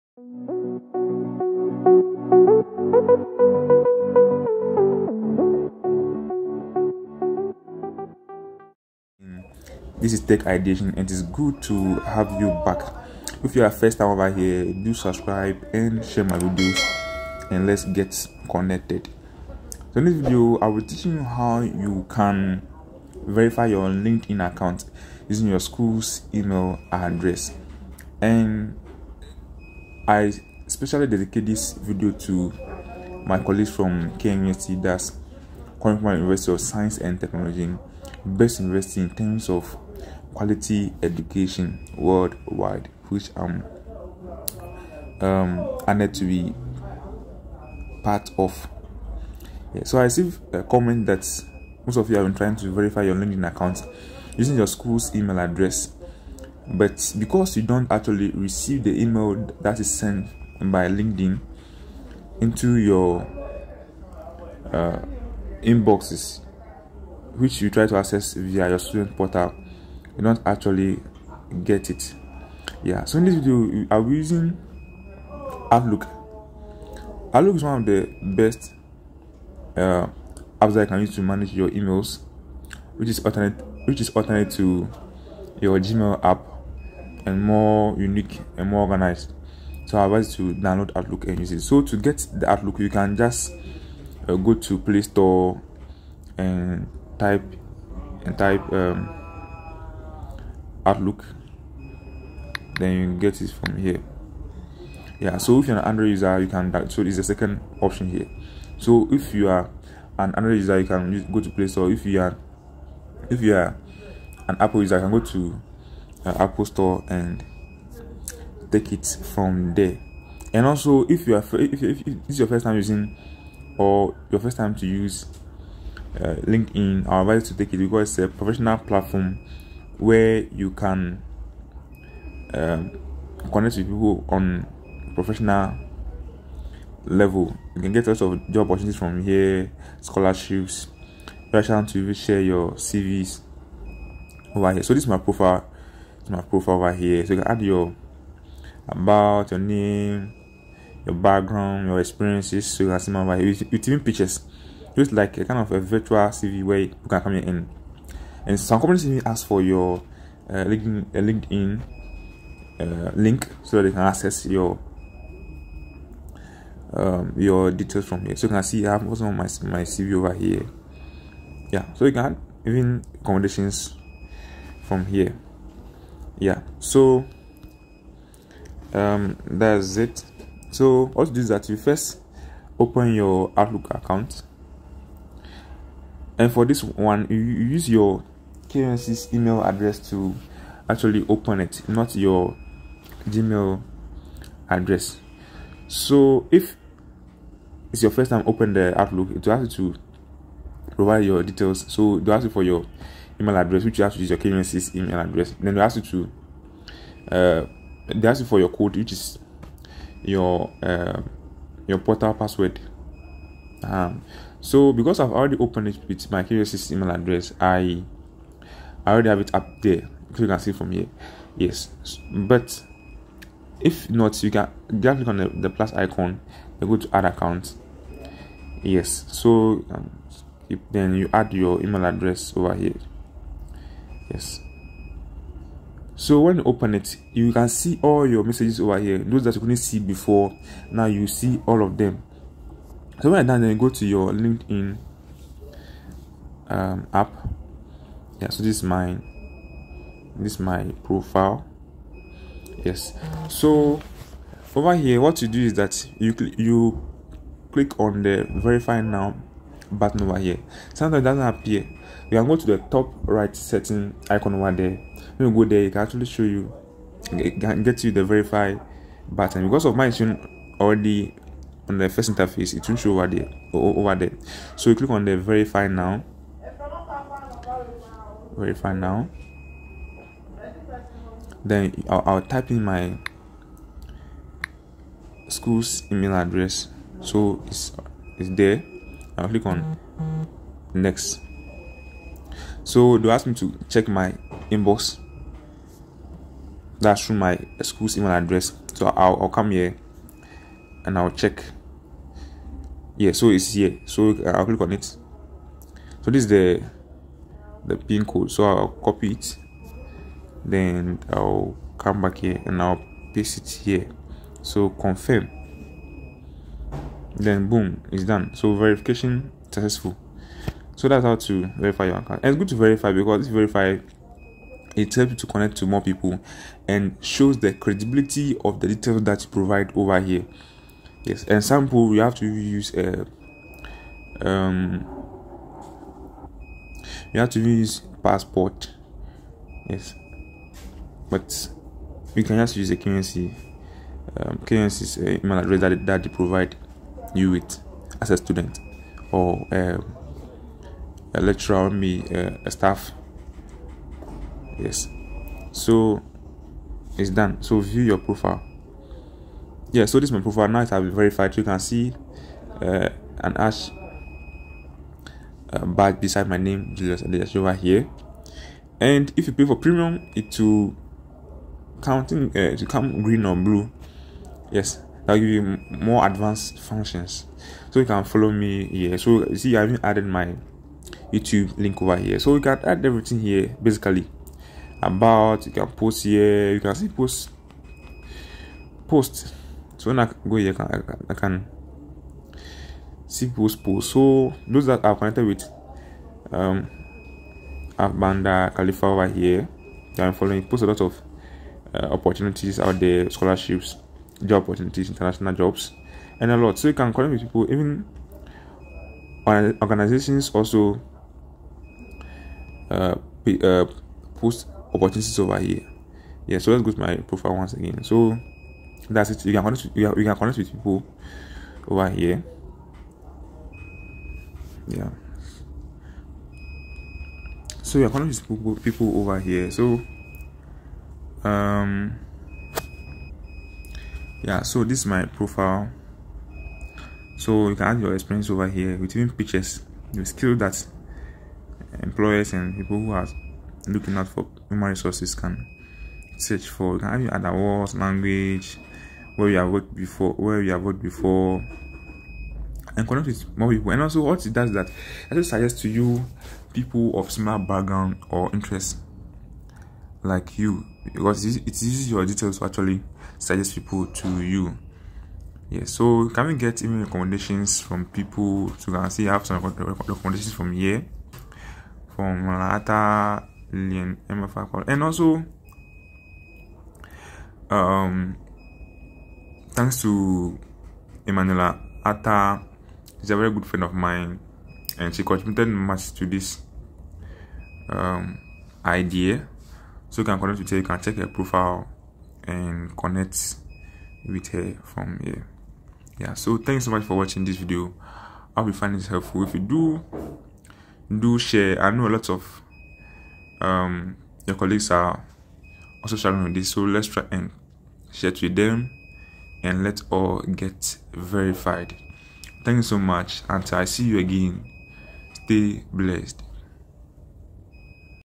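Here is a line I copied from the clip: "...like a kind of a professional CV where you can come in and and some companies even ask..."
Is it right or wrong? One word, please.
wrong.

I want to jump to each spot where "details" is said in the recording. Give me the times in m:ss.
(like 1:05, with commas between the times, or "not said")
2:47, 3:21, 5:28, 7:42.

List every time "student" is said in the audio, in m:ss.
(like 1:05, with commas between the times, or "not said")
1:08, 5:48.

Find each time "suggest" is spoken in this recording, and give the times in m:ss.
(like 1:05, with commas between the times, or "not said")
7:35, 7:43.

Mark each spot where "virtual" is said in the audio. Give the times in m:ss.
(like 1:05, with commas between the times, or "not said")
2:35.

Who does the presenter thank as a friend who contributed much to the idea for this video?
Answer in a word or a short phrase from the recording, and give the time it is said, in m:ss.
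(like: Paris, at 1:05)
Emanuela Ata, at 8:01.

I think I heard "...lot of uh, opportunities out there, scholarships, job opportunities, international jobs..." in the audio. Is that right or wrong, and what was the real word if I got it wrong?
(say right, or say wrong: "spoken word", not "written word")
right.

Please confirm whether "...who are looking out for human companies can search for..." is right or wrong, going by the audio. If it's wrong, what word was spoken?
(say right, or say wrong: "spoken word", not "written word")
wrong: "resources", not "companies".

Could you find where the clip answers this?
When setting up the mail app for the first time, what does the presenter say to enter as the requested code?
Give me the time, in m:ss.
3:31.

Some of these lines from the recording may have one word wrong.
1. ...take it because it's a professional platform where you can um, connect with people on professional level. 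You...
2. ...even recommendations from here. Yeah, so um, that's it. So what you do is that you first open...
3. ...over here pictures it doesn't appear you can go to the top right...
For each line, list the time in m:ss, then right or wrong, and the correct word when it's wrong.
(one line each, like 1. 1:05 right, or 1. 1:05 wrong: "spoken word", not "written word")
1. 2:07 right
2. 2:52 wrong: "accommodations", not "recommendations"
3. 4:20 wrong: "sometimes", not "pictures".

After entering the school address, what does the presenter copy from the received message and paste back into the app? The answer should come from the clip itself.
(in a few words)
pin code.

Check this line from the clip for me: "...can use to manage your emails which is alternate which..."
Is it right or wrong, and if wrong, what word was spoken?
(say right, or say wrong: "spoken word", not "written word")
right.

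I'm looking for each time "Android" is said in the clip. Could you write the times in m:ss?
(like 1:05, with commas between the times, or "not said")
1:45, 1:50.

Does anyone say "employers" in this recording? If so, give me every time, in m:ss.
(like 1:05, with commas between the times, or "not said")
7:22.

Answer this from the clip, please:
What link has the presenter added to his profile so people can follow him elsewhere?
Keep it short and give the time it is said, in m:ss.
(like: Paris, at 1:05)
YouTube link, at 6:21.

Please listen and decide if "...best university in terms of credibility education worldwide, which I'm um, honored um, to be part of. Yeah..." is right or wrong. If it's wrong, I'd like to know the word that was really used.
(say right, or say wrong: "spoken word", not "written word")
wrong: "quality", not "credibility".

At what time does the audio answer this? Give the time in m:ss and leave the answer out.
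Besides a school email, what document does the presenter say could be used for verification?
5:38.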